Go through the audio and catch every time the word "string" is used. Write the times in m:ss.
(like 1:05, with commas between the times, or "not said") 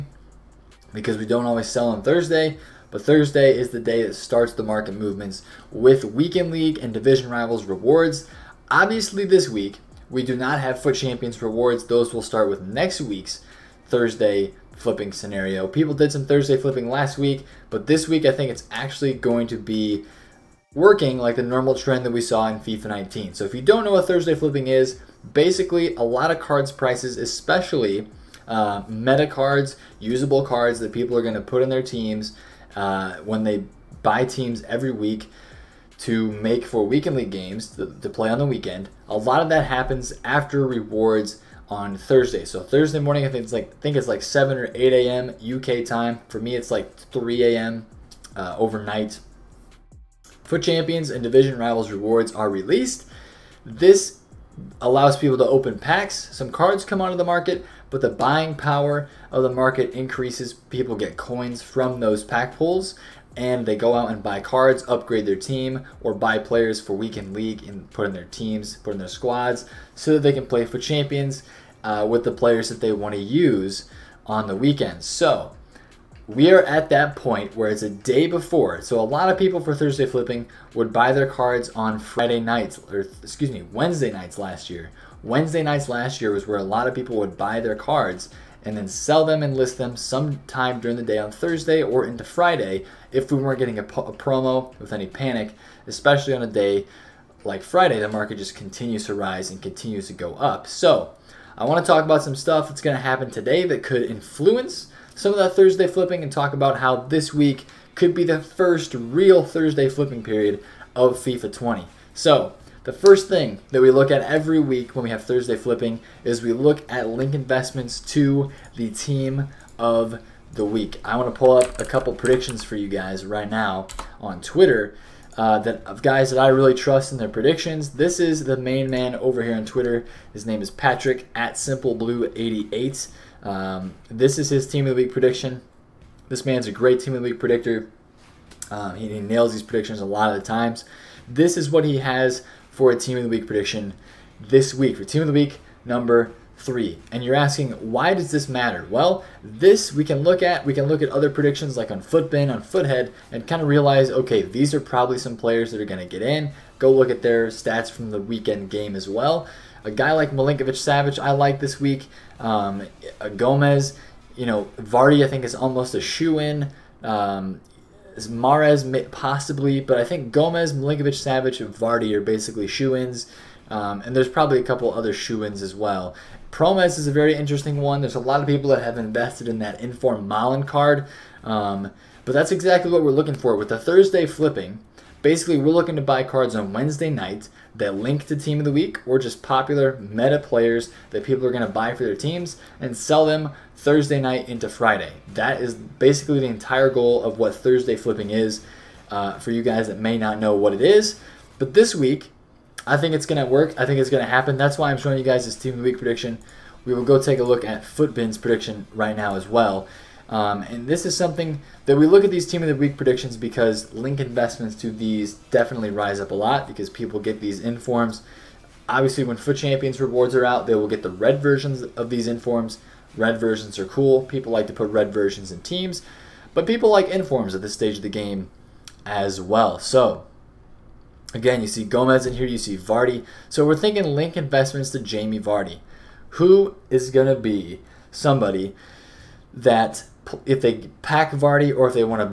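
not said.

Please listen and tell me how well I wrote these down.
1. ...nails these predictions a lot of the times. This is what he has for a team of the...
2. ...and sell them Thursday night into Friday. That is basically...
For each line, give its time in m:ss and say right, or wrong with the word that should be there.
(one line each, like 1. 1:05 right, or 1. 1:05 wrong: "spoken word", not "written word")
1. 2:19 right
2. 3:12 right.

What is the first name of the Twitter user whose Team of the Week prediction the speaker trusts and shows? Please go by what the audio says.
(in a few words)
Patrick.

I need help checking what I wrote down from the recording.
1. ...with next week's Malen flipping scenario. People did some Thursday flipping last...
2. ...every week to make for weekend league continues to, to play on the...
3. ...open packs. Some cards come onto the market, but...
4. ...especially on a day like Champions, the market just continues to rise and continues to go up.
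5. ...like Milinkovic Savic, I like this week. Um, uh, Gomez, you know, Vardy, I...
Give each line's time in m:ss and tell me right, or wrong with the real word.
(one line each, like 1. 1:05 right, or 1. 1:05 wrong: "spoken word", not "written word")
1. 0:12 wrong: "Thursday", not "Malen"
2. 0:34 wrong: "games", not "continues"
3. 0:55 right
4. 1:35 wrong: "Friday", not "Champions"
5. 2:40 right.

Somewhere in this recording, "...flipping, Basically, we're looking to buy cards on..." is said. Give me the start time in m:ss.
3:04.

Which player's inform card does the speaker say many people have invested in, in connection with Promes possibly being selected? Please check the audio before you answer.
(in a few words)
Malen.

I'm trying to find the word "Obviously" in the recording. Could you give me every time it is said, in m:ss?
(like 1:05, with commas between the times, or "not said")
0:08, 3:38.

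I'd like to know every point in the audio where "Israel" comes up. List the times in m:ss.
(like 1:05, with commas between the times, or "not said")
not said.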